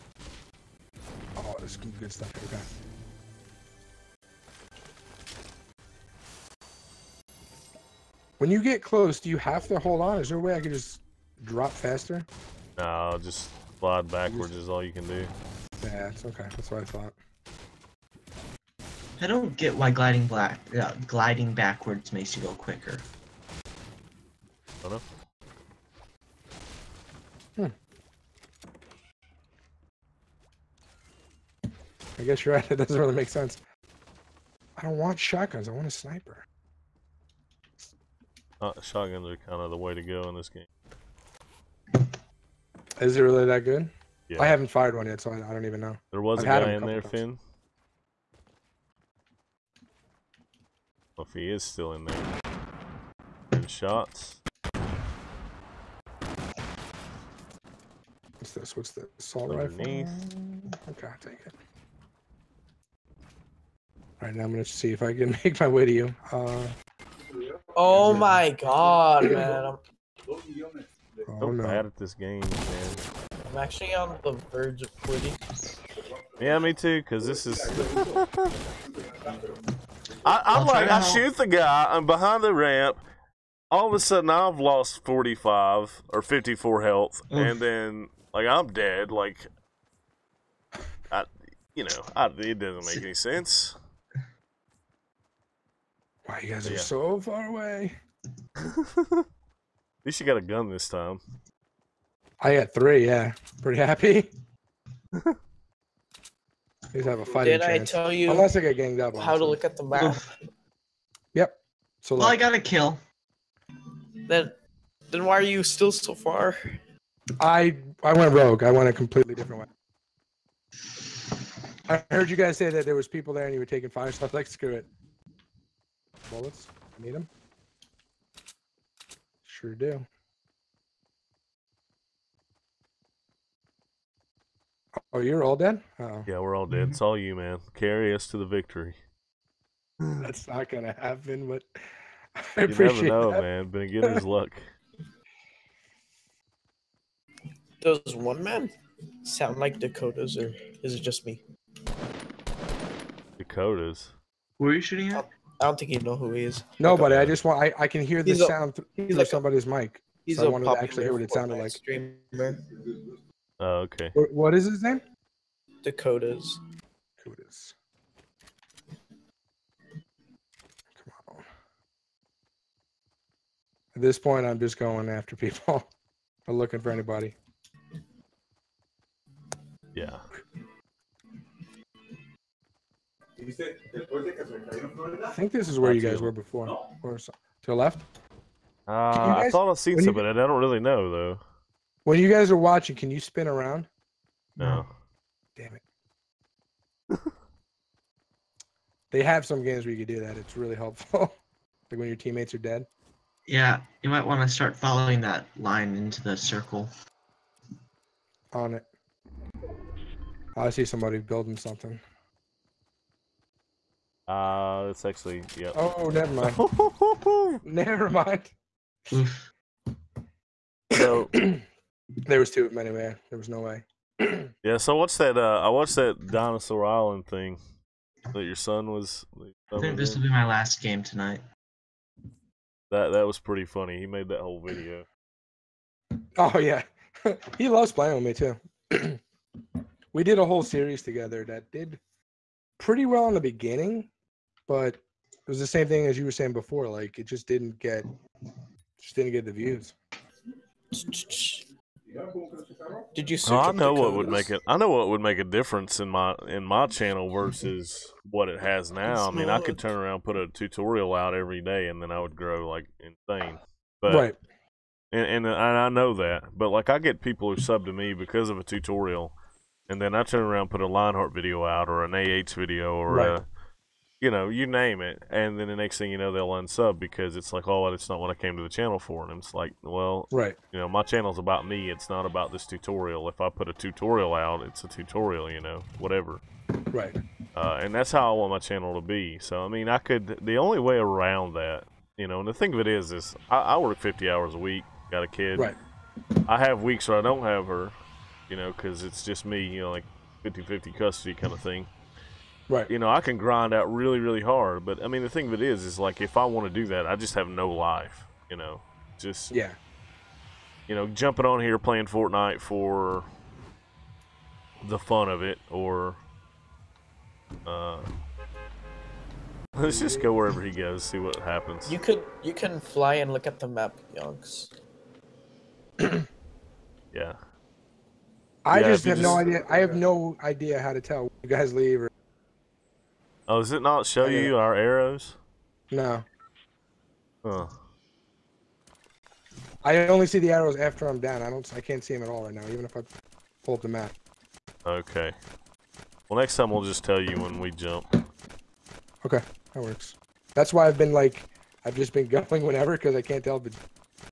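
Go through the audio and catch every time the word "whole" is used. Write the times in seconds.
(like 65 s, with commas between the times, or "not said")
234 s, 240 s.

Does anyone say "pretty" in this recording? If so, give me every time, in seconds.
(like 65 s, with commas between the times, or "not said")
103 s, 233 s, 242 s.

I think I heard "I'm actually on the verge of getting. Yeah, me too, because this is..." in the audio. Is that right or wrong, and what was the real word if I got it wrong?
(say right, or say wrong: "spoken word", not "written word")
wrong: "quitting", not "getting".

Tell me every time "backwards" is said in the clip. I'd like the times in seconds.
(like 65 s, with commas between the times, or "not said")
14 s, 21 s.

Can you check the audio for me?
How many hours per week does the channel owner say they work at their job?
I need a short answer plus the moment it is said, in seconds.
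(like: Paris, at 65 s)
50, at 293 s.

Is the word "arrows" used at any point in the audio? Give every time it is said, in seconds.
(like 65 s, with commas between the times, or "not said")
334 s, 340 s.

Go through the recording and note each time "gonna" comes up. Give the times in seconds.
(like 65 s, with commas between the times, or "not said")
64 s.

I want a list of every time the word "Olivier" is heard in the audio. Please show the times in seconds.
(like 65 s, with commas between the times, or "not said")
not said.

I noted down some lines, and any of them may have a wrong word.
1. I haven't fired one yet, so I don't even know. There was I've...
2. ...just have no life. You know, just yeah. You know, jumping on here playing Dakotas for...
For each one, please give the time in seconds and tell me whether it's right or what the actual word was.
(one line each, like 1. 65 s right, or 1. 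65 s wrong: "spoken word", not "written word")
1. 44 s right
2. 307 s wrong: "Fortnite", not "Dakotas".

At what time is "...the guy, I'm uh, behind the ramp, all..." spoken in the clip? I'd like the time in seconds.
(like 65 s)
81 s.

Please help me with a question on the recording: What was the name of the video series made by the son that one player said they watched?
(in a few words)
Dinosaur Island.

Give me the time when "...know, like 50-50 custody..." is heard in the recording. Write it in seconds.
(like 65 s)
299 s.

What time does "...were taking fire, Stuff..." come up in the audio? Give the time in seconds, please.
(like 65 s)
123 s.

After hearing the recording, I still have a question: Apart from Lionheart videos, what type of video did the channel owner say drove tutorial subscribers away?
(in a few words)
AH video.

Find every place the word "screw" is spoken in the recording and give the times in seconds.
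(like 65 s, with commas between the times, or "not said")
124 s.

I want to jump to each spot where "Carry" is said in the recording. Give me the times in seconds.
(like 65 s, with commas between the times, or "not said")
137 s.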